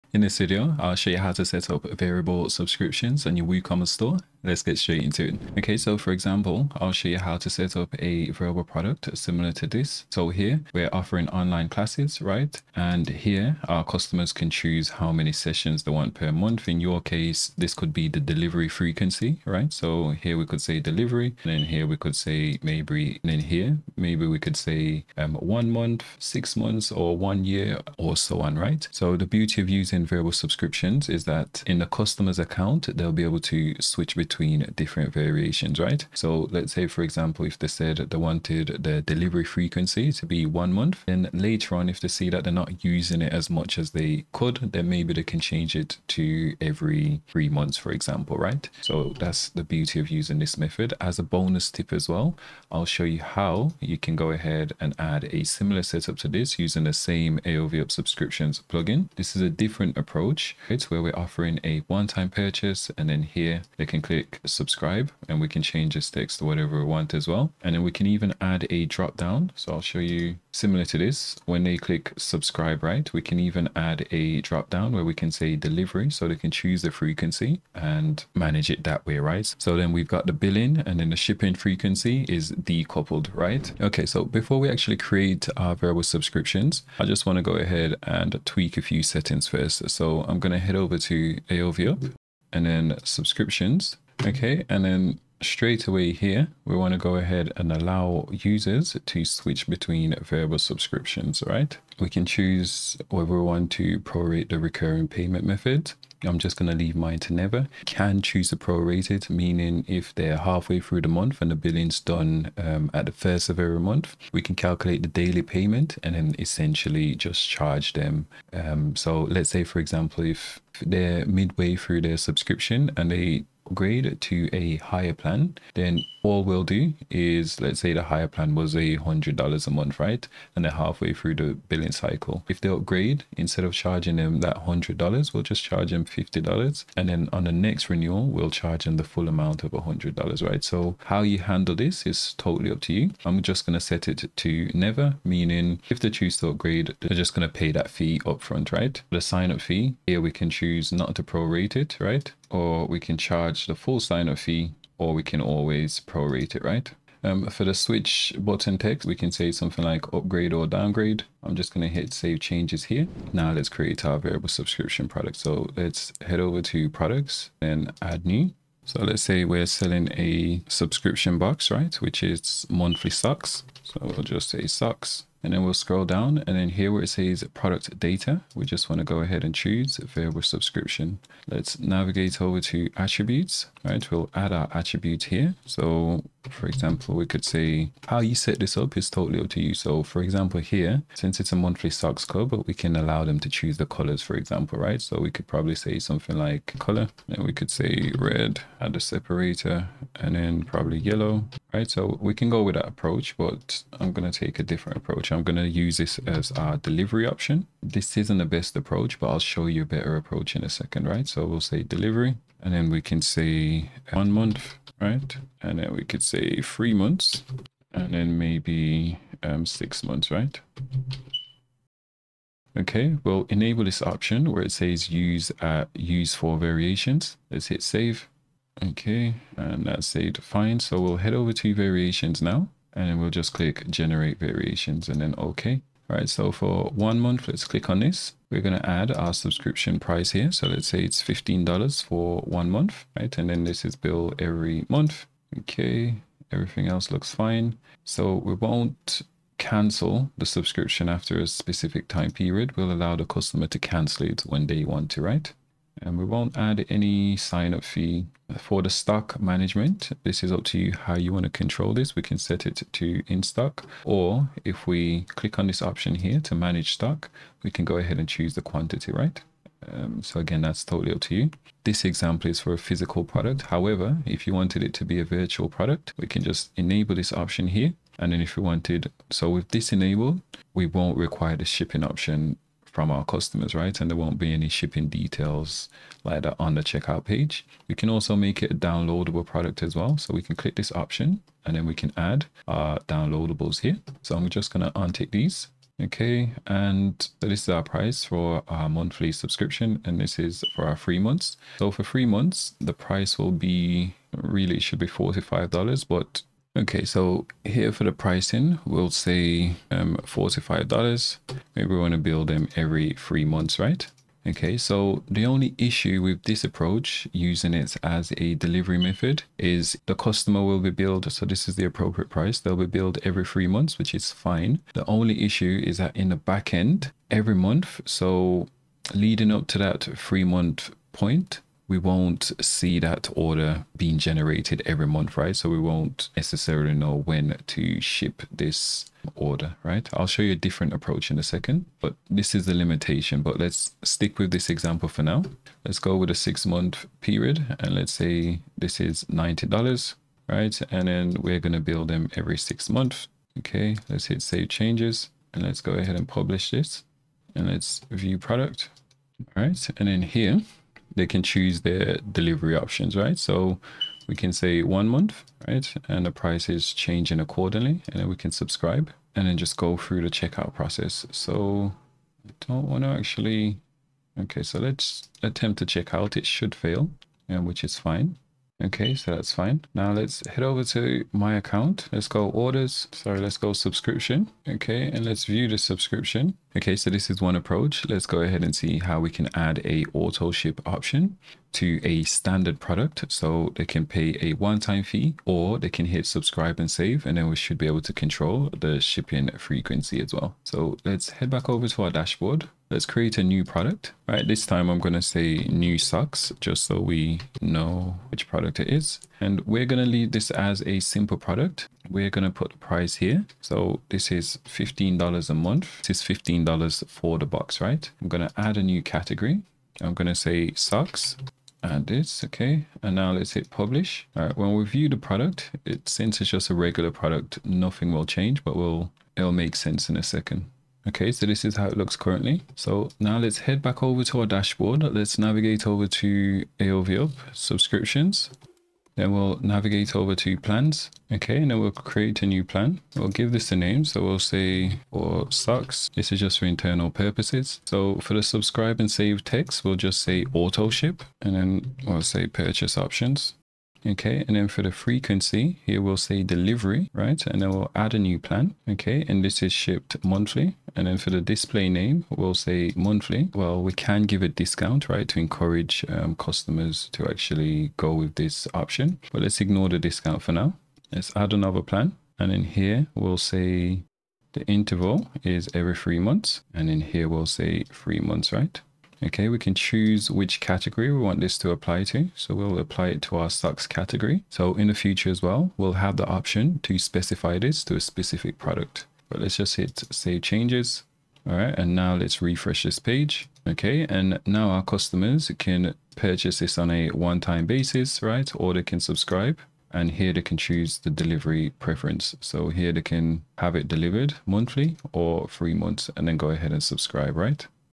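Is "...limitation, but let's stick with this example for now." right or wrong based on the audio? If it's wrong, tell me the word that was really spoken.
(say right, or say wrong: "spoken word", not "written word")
right.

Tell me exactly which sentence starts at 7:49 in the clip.
But let's ignore the discount for now.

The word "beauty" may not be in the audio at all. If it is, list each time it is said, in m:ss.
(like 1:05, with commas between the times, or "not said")
0:29, 0:49.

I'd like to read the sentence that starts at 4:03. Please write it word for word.
And then this is bill every month.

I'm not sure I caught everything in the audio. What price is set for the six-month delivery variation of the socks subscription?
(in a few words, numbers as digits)
$90.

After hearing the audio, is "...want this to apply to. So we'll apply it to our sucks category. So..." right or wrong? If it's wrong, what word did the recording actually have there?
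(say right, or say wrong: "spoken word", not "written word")
right.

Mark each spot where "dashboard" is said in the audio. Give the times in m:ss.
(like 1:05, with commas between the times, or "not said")
6:42, 7:14.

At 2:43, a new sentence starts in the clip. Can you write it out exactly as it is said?
Now let's create our variable subscription product.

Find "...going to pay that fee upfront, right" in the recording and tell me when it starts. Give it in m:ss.
2:27.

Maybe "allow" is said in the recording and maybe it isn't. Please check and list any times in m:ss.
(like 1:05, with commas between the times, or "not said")
1:37, 3:12, 4:12.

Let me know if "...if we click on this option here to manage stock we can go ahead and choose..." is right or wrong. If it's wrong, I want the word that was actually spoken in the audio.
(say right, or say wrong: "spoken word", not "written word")
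right.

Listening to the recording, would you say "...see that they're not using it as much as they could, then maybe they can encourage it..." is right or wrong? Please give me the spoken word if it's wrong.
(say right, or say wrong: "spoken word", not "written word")
wrong: "change", not "encourage".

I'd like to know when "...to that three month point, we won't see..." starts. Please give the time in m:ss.
5:29.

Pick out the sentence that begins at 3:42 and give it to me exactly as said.
Okay, we'll enable this option where it says use uh, use for variations.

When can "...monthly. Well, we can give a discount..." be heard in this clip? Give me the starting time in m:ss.
7:42.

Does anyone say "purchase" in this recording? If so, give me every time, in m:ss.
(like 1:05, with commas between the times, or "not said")
1:02, 7:32, 8:16.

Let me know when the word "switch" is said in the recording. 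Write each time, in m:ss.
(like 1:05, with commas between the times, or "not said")
0:33, 1:39, 2:37.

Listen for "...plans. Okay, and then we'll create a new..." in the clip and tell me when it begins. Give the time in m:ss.
7:20.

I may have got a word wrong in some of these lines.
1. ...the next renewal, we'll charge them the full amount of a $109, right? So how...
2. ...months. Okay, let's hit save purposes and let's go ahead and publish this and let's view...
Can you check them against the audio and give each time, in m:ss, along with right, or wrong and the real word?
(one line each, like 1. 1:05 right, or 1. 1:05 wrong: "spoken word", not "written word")
1. 2:17 wrong: "100", not "109"
2. 5:52 wrong: "changes", not "purposes".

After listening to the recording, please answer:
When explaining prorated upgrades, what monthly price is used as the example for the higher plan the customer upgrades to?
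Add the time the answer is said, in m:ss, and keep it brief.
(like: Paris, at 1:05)
$100, at 2:08.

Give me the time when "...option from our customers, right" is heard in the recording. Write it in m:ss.
4:42.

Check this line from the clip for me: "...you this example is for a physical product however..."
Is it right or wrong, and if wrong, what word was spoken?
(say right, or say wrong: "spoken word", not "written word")
right.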